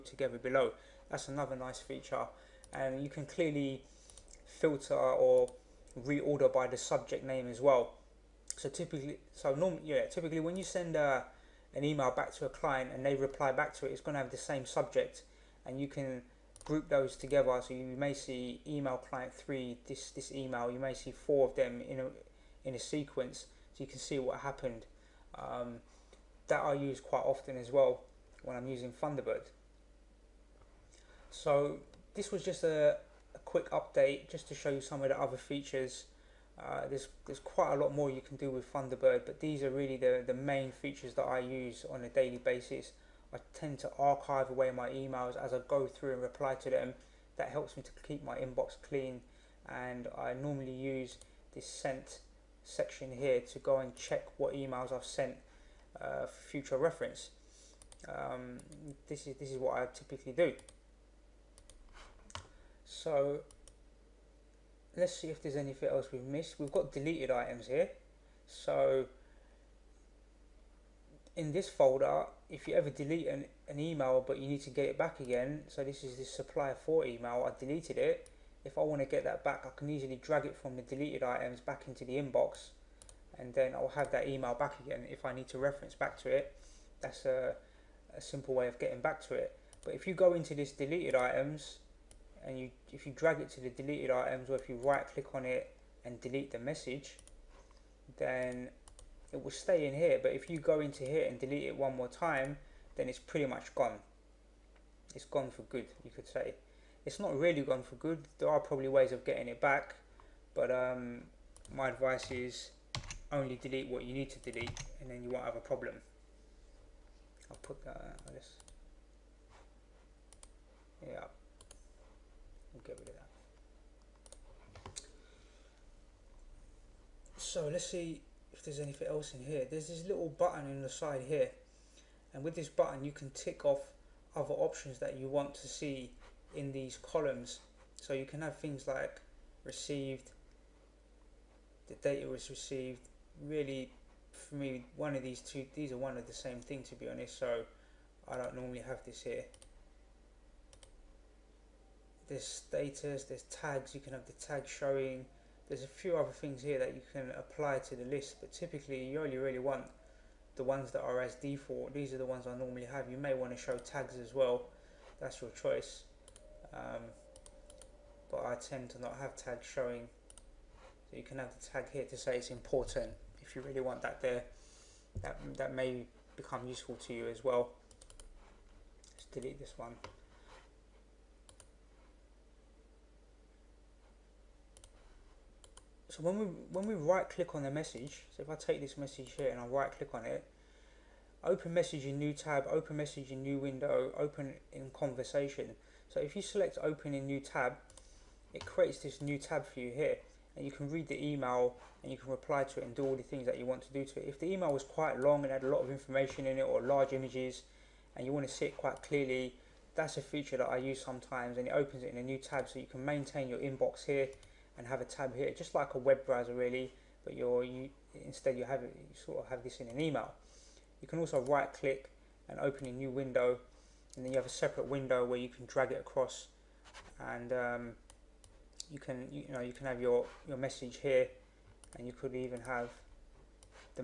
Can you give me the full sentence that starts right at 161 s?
These are the ones I normally have.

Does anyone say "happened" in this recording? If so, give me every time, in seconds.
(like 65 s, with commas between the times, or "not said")
24 s.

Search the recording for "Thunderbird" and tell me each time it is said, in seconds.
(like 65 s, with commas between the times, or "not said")
29 s, 38 s.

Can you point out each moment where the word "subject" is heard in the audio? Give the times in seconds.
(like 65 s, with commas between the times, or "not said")
6 s, 14 s.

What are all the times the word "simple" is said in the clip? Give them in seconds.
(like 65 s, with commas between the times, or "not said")
88 s.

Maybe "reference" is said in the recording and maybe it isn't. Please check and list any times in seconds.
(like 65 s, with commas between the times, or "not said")
56 s, 85 s.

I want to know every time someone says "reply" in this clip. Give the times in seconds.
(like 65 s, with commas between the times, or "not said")
13 s, 46 s, 202 s.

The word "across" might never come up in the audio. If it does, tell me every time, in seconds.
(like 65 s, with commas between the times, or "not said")
225 s.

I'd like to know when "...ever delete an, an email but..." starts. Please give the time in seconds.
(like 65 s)
72 s.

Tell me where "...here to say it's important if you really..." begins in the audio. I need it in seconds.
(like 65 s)
171 s.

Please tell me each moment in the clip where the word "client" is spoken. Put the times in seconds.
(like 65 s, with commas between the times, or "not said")
12 s, 18 s.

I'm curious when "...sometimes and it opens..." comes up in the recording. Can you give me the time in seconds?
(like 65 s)
211 s.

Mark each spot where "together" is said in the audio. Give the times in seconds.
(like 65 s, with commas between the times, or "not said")
0 s, 17 s.